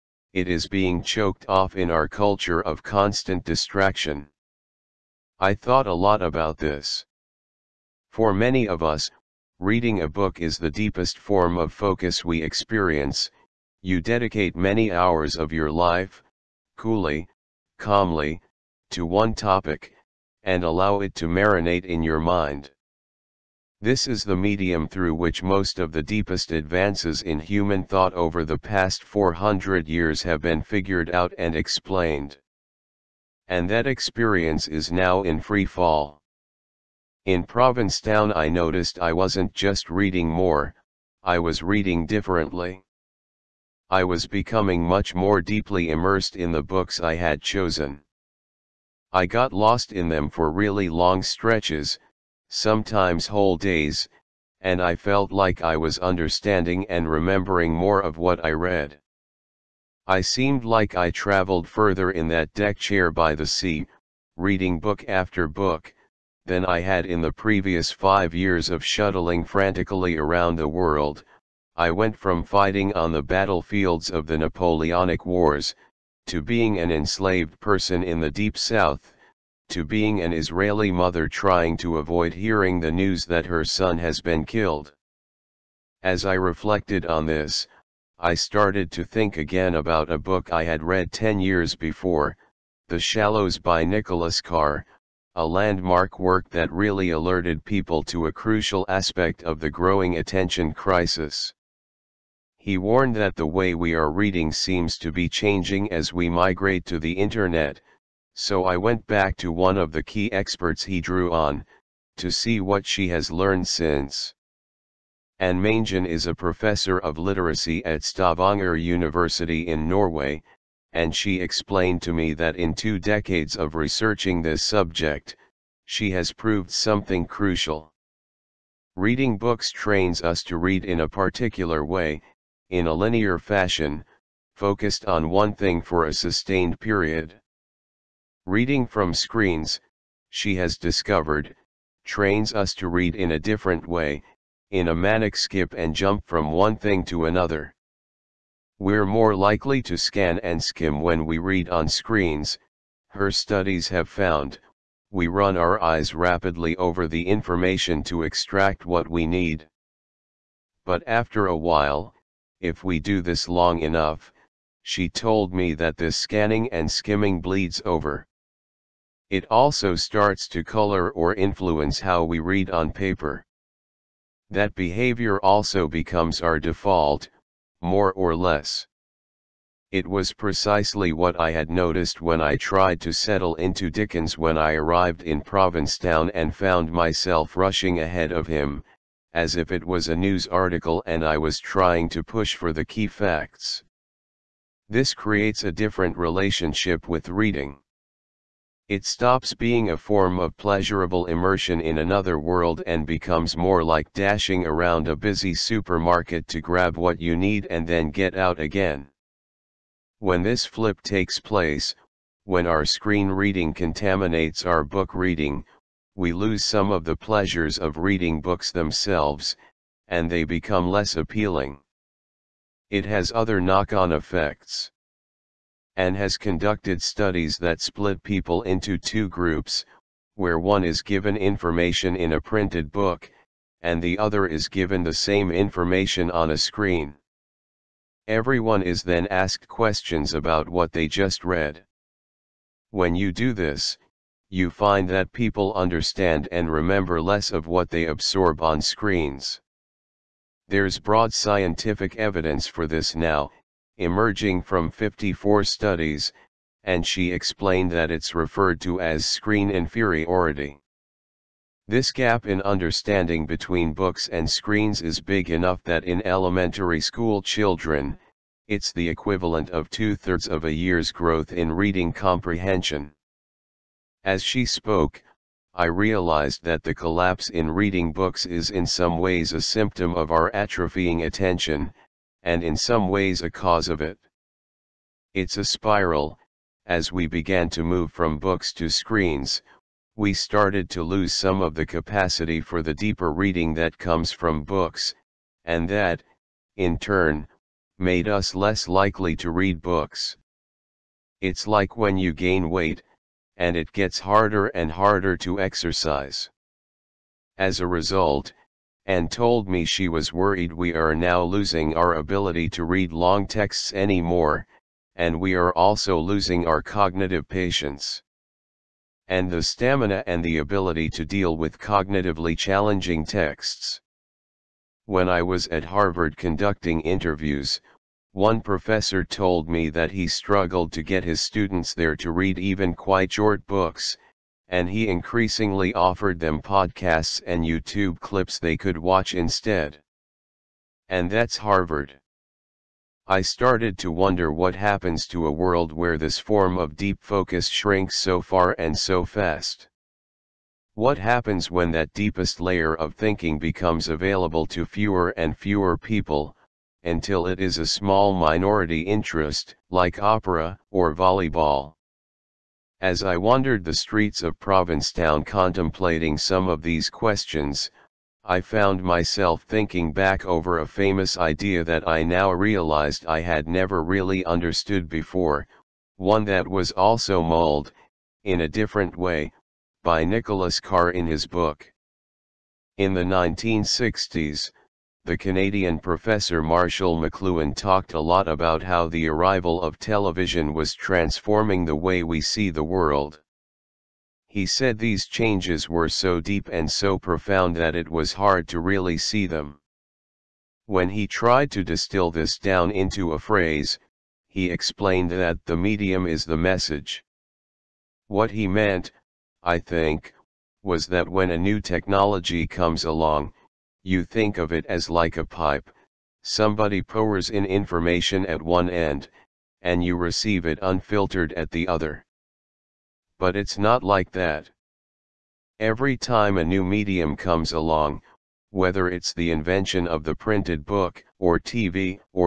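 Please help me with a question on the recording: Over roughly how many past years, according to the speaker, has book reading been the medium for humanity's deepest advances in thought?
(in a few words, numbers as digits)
400.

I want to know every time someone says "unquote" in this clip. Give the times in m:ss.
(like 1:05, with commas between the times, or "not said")
not said.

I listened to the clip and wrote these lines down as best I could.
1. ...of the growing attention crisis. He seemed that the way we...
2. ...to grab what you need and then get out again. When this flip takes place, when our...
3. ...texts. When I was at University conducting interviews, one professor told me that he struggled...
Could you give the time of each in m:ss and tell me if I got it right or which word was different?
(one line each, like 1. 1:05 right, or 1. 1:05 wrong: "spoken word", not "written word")
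1. 1:39 wrong: "warned", not "seemed"
2. 3:26 right
3. 5:23 wrong: "Harvard", not "University".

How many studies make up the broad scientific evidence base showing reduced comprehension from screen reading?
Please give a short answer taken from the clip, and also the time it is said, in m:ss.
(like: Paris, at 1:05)
54, at 4:14.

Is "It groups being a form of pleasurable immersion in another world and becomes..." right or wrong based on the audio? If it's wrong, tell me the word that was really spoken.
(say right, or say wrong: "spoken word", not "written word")
wrong: "stops", not "groups".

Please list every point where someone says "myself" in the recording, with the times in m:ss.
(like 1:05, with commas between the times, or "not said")
3:06, 6:09.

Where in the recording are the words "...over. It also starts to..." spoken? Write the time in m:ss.
2:47.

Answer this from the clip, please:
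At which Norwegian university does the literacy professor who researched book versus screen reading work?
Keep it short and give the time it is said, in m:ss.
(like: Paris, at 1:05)
Stavanger University, at 1:58.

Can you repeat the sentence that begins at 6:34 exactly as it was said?
He said these changes were so deep and so profound that it was hard to really see them.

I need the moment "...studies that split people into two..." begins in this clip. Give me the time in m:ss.
3:47.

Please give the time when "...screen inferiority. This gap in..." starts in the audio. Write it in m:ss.
4:19.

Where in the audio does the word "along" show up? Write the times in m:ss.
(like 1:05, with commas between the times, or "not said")
6:53, 7:07.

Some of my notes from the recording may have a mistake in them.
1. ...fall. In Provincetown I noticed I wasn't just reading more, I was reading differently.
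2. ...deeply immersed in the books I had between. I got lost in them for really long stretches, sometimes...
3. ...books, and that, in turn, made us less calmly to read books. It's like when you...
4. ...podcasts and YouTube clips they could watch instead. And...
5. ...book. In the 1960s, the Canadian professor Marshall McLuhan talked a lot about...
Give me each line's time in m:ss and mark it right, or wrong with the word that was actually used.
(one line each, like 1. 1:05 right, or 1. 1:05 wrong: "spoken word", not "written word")
1. 0:35 right
2. 0:45 wrong: "chosen", not "between"
3. 4:54 wrong: "likely", not "calmly"
4. 5:36 right
5. 6:21 right.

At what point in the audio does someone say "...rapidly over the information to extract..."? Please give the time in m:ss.
2:36.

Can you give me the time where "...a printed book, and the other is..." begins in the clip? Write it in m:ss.
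3:52.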